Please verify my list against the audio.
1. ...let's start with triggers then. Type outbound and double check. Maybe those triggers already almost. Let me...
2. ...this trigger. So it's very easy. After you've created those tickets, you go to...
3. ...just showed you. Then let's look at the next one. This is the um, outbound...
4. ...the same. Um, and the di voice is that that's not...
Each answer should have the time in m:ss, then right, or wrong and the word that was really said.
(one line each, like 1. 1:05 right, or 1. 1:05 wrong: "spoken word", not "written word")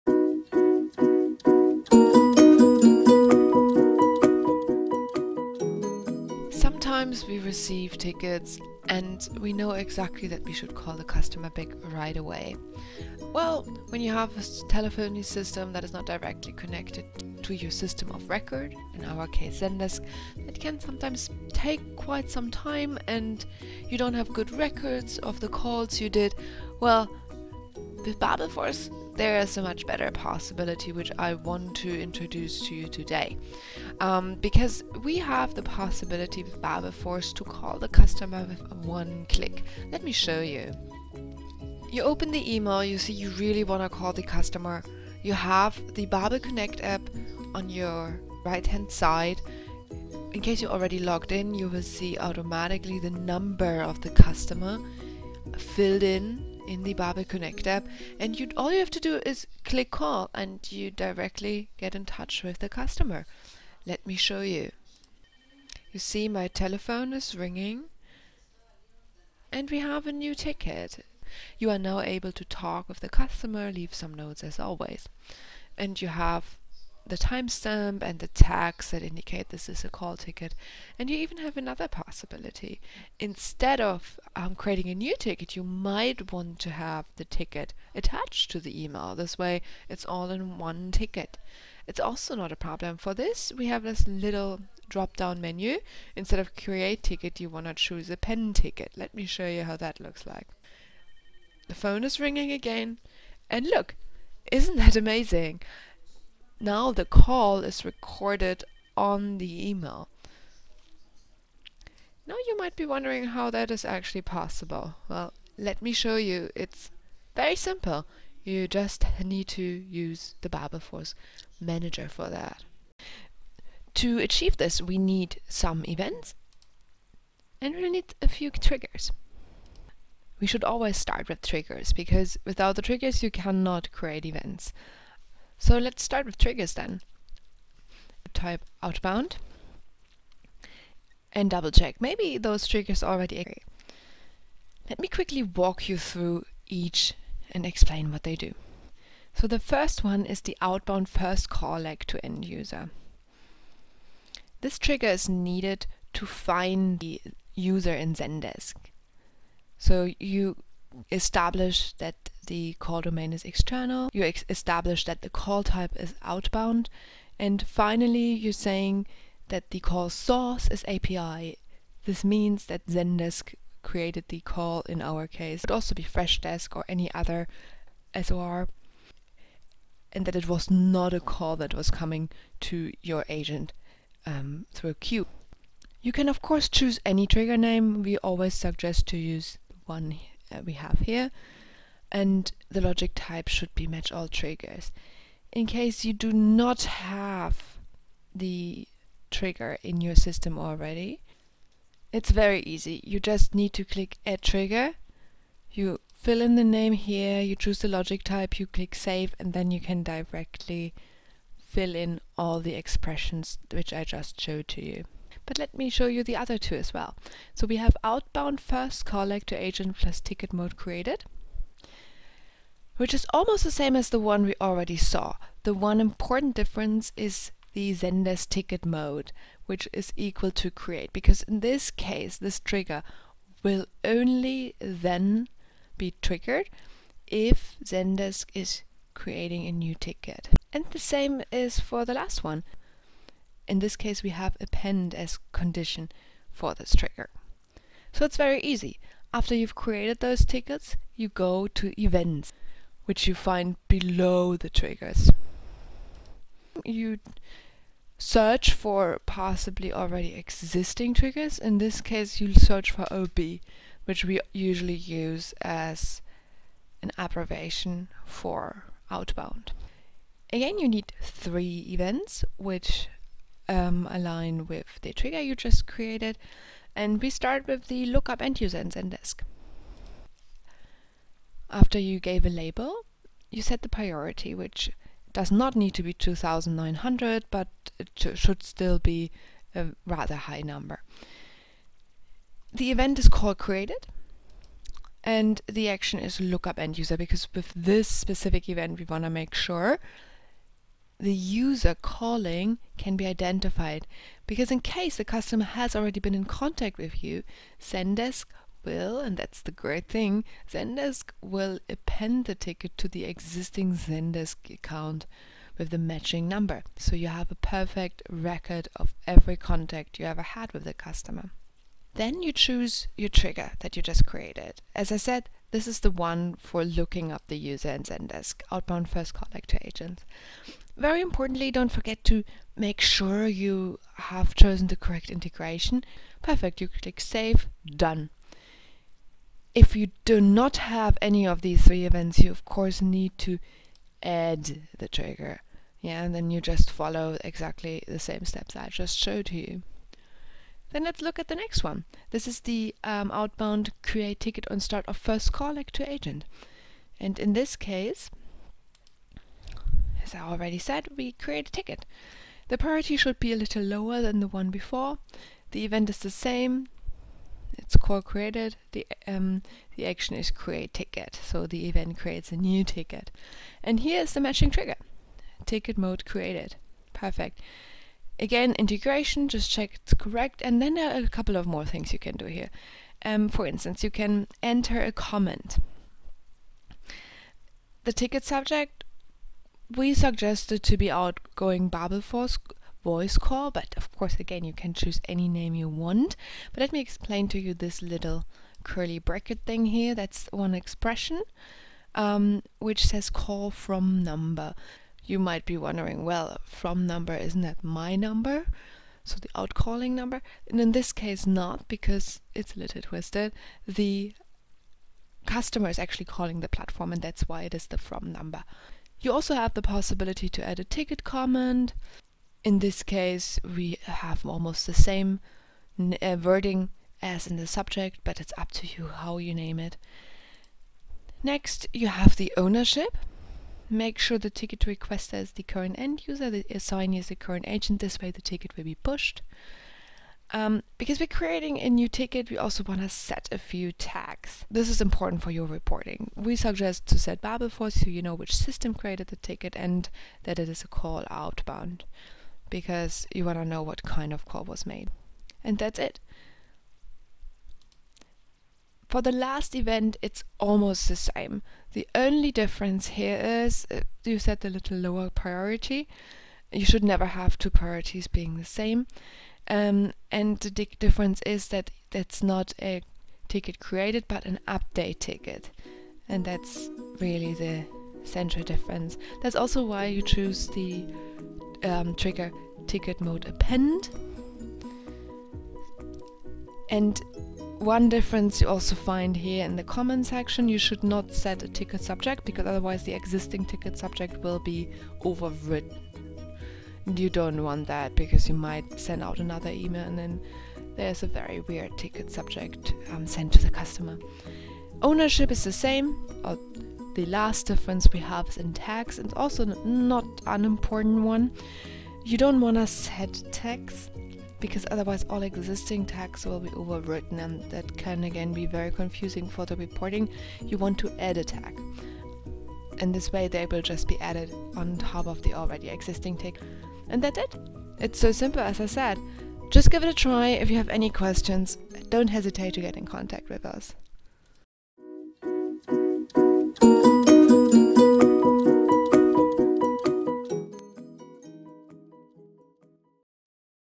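1. 2:15 wrong: "exist", not "almost"
2. 4:06 right
3. 5:48 right
4. 7:48 wrong: "difference", not "voice".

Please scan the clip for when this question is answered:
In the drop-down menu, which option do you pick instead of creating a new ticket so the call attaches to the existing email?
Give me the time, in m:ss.
1:38.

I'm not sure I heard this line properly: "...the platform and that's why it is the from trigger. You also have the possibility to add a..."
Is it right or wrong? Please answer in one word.
wrong.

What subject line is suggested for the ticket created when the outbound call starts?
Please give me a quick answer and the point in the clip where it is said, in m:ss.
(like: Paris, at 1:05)
Outgoing Babelforce voice call, at 6:31.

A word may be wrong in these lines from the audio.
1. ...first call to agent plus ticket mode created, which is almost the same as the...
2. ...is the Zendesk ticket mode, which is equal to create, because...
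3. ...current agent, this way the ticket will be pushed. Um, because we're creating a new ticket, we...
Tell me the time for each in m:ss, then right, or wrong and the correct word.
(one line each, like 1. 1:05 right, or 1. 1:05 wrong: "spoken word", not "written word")
1. 3:38 right
2. 3:47 right
3. 7:17 right.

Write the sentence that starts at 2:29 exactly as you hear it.
So the first one is the outbound first call leg to end user.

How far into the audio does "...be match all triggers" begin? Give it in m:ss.
3:13.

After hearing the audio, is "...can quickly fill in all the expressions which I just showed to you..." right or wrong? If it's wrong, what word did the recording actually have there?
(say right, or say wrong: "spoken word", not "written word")
wrong: "directly", not "quickly".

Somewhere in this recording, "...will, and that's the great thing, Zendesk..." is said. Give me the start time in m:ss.
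5:08.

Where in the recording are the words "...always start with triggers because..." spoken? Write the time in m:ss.
2:10.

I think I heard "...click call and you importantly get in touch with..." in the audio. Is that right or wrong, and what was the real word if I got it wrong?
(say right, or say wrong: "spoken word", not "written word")
wrong: "directly", not "importantly".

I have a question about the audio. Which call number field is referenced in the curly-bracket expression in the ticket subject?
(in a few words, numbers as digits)
call from number.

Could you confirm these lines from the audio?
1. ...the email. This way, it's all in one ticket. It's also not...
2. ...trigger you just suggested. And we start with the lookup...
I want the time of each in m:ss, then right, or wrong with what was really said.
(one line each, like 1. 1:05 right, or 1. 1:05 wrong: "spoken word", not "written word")
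1. 1:28 right
2. 4:35 wrong: "created", not "suggested".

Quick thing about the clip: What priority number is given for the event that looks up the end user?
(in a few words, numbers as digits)
2900.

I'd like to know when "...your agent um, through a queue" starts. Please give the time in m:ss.
3:03.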